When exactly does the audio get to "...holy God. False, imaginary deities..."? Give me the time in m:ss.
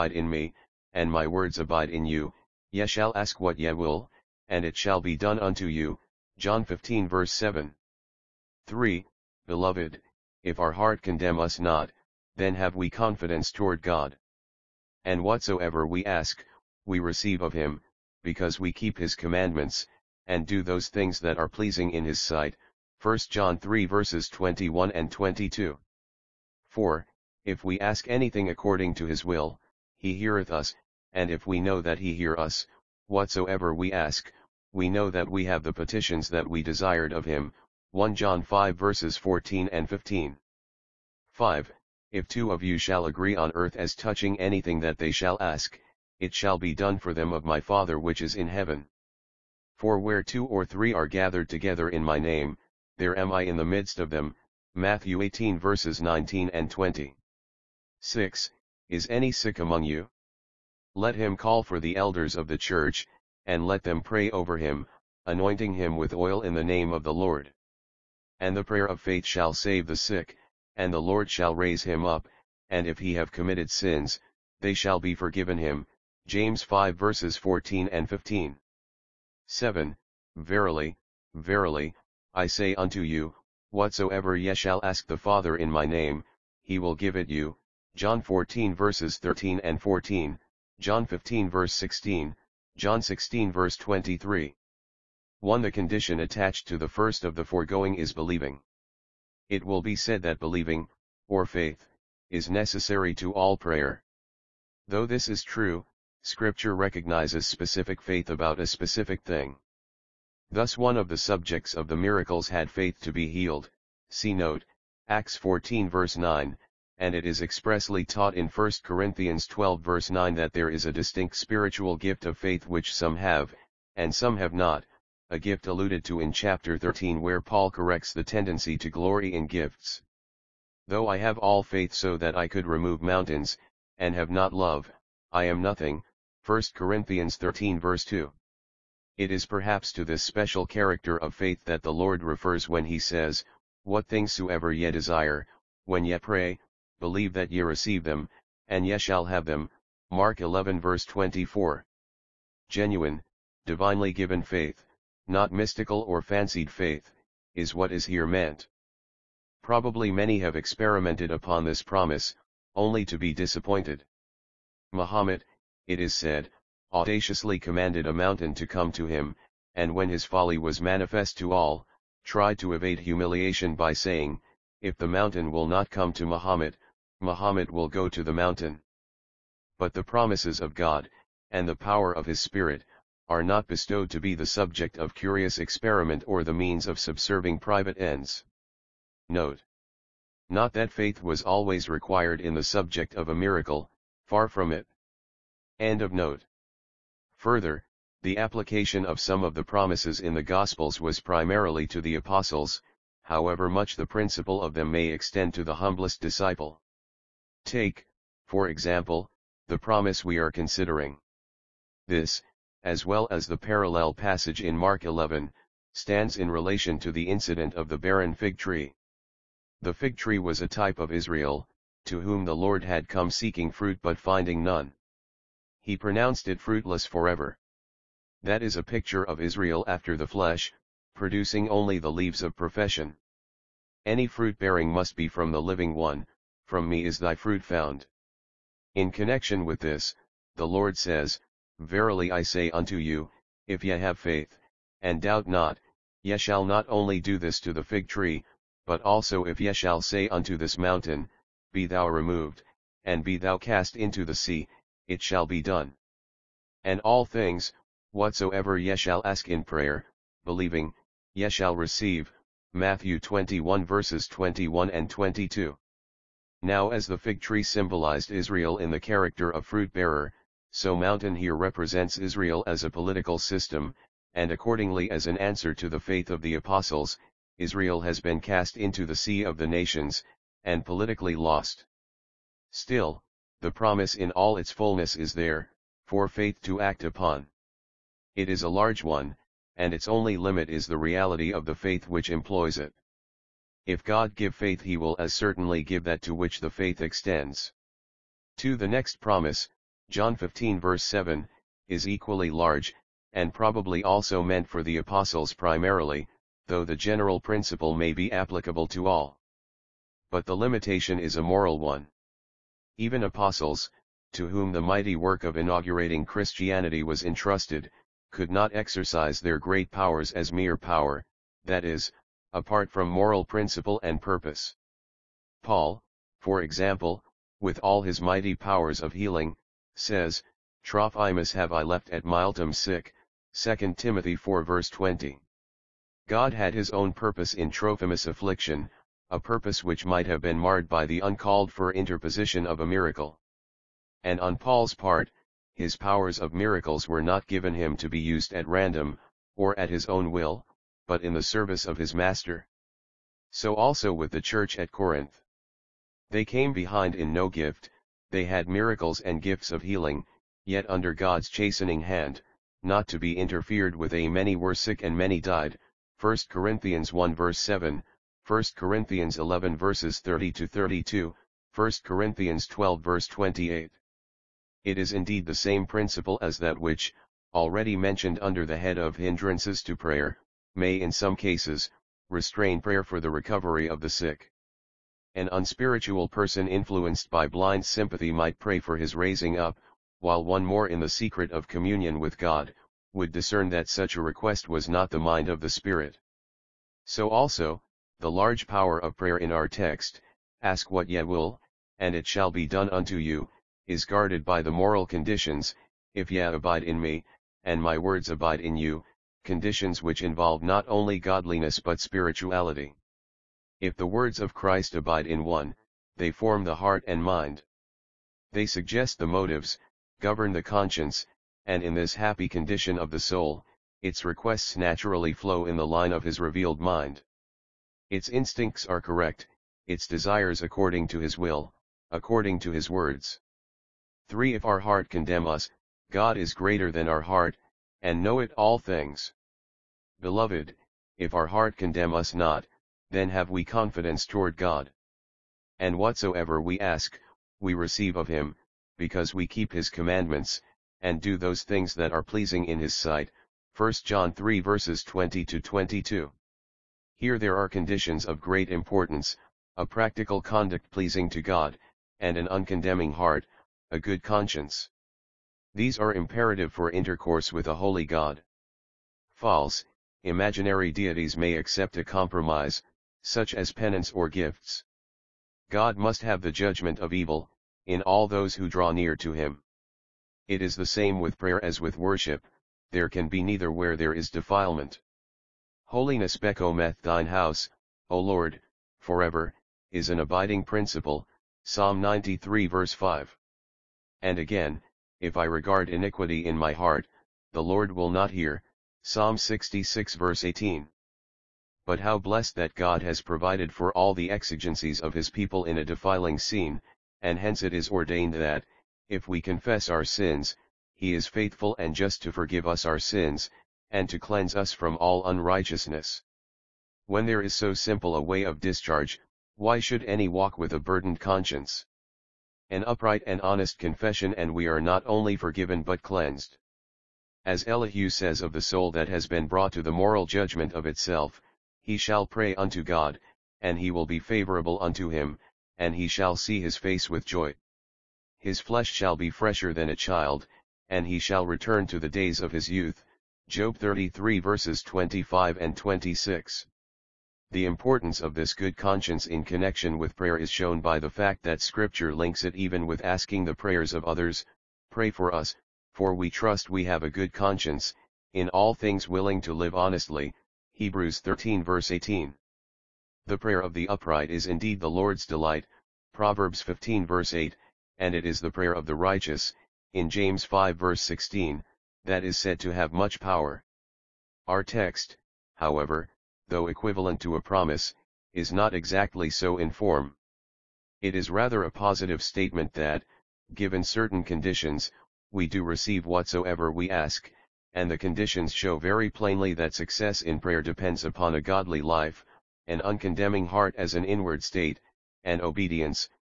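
7:47.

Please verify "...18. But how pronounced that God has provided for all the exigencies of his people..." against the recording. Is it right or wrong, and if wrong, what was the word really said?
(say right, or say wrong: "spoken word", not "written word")
wrong: "blessed", not "pronounced".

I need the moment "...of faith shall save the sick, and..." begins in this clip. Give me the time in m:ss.
1:08.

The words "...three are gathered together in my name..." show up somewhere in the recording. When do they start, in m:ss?
0:50.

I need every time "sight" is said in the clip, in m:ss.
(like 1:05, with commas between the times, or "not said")
0:22, 7:32.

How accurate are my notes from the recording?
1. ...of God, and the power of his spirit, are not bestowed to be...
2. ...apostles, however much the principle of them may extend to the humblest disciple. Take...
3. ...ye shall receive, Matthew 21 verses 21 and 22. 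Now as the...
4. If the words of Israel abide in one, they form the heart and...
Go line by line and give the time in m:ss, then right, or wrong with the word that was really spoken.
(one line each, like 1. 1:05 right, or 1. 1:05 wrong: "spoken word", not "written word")
1. 3:00 right
2. 3:22 right
3. 4:21 right
4. 6:53 wrong: "Christ", not "Israel".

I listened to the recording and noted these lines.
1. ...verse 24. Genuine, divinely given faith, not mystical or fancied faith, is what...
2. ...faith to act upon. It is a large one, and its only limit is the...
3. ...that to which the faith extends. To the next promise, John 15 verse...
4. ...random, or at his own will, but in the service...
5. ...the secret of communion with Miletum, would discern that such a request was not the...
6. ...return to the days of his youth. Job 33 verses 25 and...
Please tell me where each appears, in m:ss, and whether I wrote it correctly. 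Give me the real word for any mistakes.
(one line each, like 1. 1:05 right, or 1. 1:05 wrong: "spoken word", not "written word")
1. 2:30 right
2. 4:46 right
3. 4:56 right
4. 5:48 right
5. 6:31 wrong: "God", not "Miletum"
6. 9:01 right.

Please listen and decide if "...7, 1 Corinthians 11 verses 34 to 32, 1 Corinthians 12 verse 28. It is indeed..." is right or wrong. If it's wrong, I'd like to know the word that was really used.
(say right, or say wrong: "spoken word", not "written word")
wrong: "30", not "34".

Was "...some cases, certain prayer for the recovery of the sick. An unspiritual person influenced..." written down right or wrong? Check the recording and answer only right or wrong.
wrong.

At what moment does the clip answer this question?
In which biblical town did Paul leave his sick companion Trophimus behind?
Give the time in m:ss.
5:32.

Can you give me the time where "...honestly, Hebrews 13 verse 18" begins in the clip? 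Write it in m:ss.
9:19.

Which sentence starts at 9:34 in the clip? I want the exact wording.
Our text, however, though equivalent to a promise, is not exactly so in form.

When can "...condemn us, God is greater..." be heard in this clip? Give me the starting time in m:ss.
7:15.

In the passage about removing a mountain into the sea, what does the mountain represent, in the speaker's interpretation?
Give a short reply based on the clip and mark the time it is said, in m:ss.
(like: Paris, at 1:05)
Israel as a political system, at 4:32.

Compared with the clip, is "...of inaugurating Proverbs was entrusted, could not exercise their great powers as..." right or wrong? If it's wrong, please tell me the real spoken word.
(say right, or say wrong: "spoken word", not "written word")
wrong: "Christianity", not "Proverbs".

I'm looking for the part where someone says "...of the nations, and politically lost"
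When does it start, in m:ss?
4:39.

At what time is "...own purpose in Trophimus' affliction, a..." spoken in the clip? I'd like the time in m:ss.
5:36.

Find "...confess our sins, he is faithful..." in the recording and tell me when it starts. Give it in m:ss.
8:29.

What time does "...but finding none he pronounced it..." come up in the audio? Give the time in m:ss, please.
3:44.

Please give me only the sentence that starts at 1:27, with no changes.
John 14 verses 13 and 14, John 15 verse 16, John 16 verse 23.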